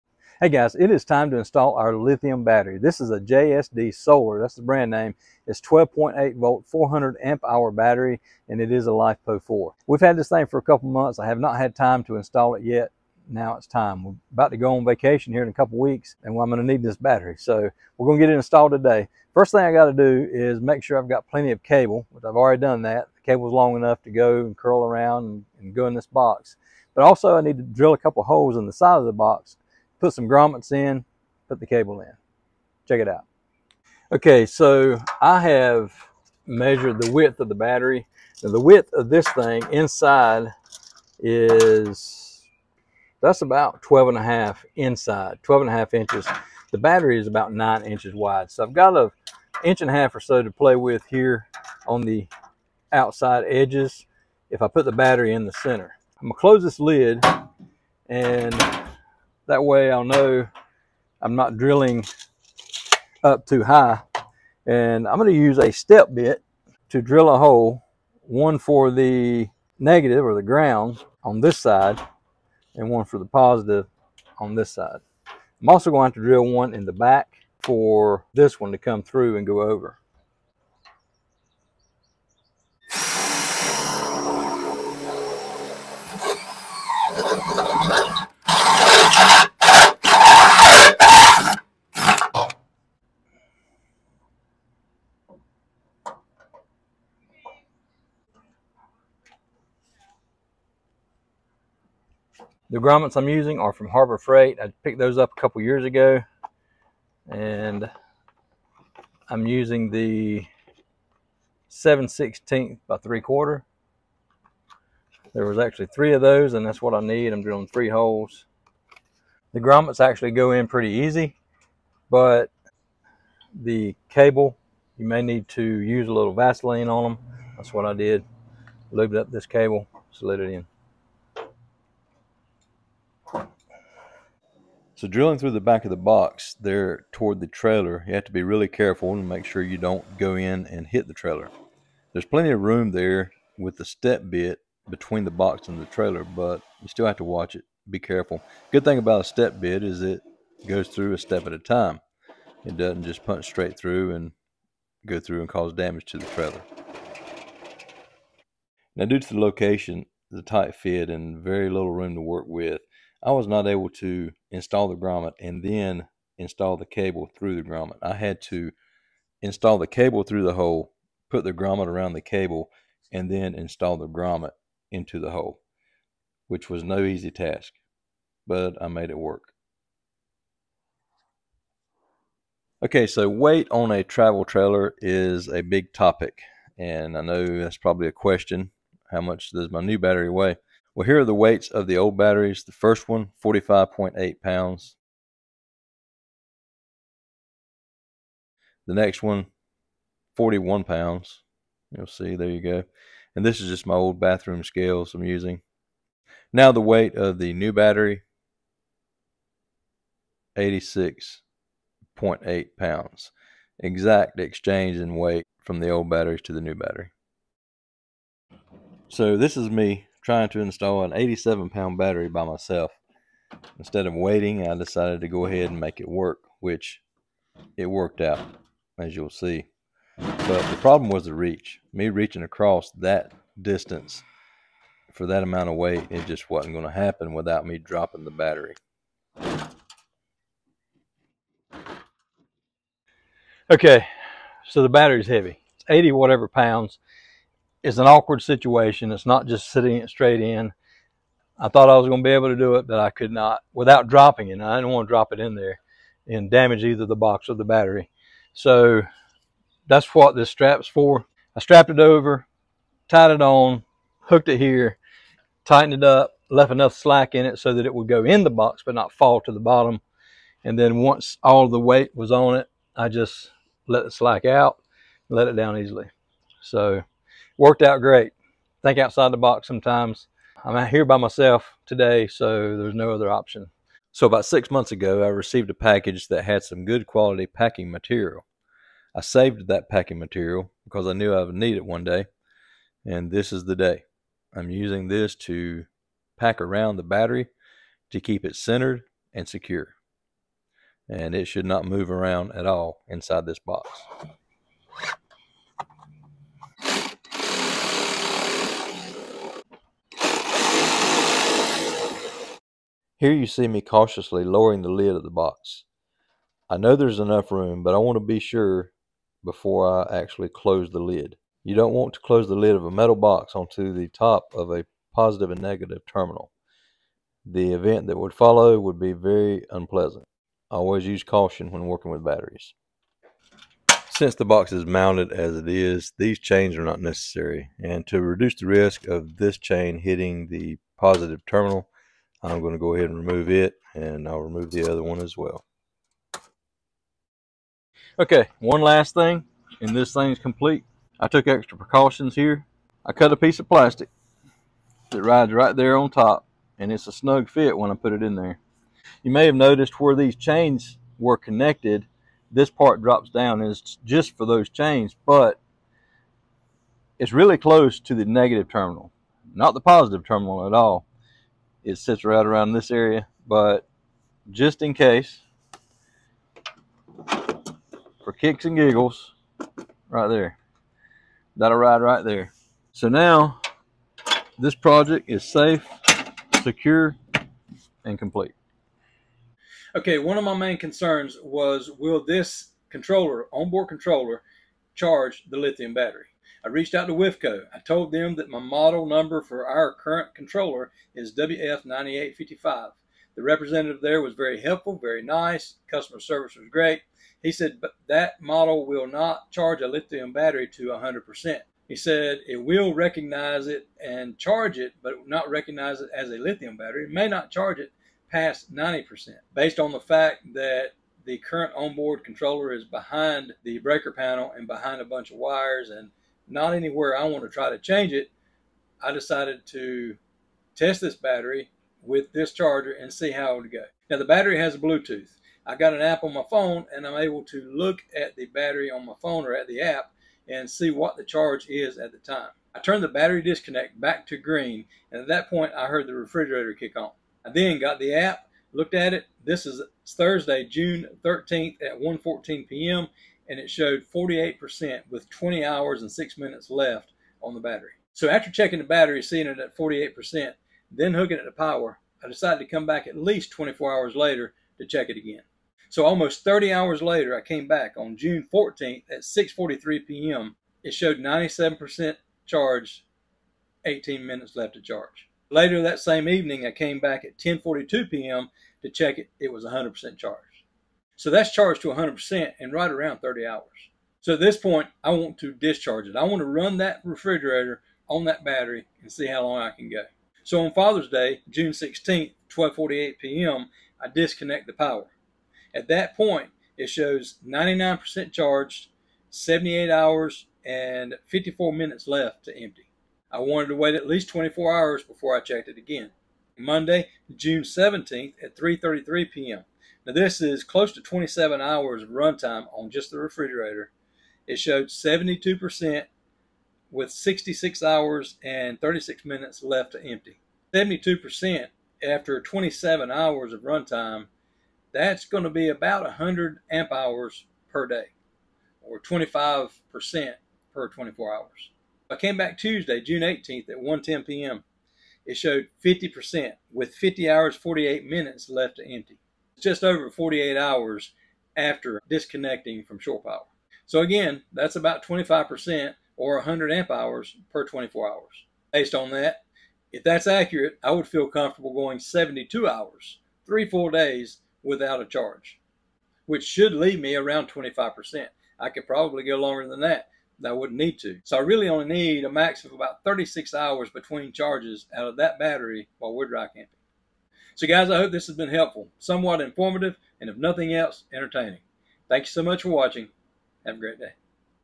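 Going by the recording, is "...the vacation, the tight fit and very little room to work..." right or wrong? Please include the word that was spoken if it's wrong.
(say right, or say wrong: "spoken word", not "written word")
wrong: "location", not "vacation".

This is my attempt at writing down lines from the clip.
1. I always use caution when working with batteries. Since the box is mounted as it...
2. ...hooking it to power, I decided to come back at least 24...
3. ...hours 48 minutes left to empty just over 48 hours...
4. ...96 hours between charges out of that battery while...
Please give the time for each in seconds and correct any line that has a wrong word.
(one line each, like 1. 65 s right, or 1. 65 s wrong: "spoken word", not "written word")
1. 330 s right
2. 461 s right
3. 537 s right
4. 563 s wrong: "36", not "96".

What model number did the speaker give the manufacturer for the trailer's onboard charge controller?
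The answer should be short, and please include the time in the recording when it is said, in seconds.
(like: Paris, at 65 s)
WF9855, at 401 s.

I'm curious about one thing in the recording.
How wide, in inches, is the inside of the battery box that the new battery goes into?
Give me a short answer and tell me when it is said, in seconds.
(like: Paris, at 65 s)
12 and a half inches, at 45 s.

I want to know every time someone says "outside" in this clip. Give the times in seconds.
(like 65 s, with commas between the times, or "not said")
52 s, 278 s.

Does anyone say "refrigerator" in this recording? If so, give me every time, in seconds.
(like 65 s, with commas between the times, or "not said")
446 s, 487 s, 513 s.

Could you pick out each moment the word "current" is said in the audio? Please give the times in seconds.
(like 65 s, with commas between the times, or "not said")
399 s, 421 s.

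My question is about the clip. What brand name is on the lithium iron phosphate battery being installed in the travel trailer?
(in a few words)
JSD Solar.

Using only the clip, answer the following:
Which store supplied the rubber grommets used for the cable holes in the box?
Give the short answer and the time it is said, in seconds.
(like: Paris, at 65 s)
Harbor Freight, at 103 s.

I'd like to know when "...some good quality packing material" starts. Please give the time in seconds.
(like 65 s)
286 s.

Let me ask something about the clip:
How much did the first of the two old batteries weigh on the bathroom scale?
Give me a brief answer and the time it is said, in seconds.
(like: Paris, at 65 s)
45.8 pounds, at 193 s.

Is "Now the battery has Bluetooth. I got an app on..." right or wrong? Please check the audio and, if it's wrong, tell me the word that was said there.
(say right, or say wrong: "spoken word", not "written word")
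right.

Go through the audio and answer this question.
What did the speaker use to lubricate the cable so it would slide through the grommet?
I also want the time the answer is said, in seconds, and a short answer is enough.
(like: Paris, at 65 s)
Vaseline, at 126 s.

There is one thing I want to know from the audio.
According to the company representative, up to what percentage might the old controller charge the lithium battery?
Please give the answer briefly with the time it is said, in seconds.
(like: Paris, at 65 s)
90%, at 418 s.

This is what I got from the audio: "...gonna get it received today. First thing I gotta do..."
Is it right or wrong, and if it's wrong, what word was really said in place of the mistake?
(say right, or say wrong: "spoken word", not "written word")
wrong: "installed", not "received".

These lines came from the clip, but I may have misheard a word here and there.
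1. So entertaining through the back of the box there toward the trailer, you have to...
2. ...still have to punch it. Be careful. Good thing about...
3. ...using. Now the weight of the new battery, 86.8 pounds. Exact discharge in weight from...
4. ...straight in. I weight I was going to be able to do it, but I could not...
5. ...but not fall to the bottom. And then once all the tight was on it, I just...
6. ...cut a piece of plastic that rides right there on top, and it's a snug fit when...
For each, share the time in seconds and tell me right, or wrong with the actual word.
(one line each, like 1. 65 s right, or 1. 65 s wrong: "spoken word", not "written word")
1. 135 s wrong: "drilling", not "entertaining"
2. 146 s wrong: "watch", not "punch"
3. 205 s wrong: "exchange", not "discharge"
4. 250 s wrong: "thought", not "weight"
5. 268 s wrong: "weight", not "tight"
6. 353 s right.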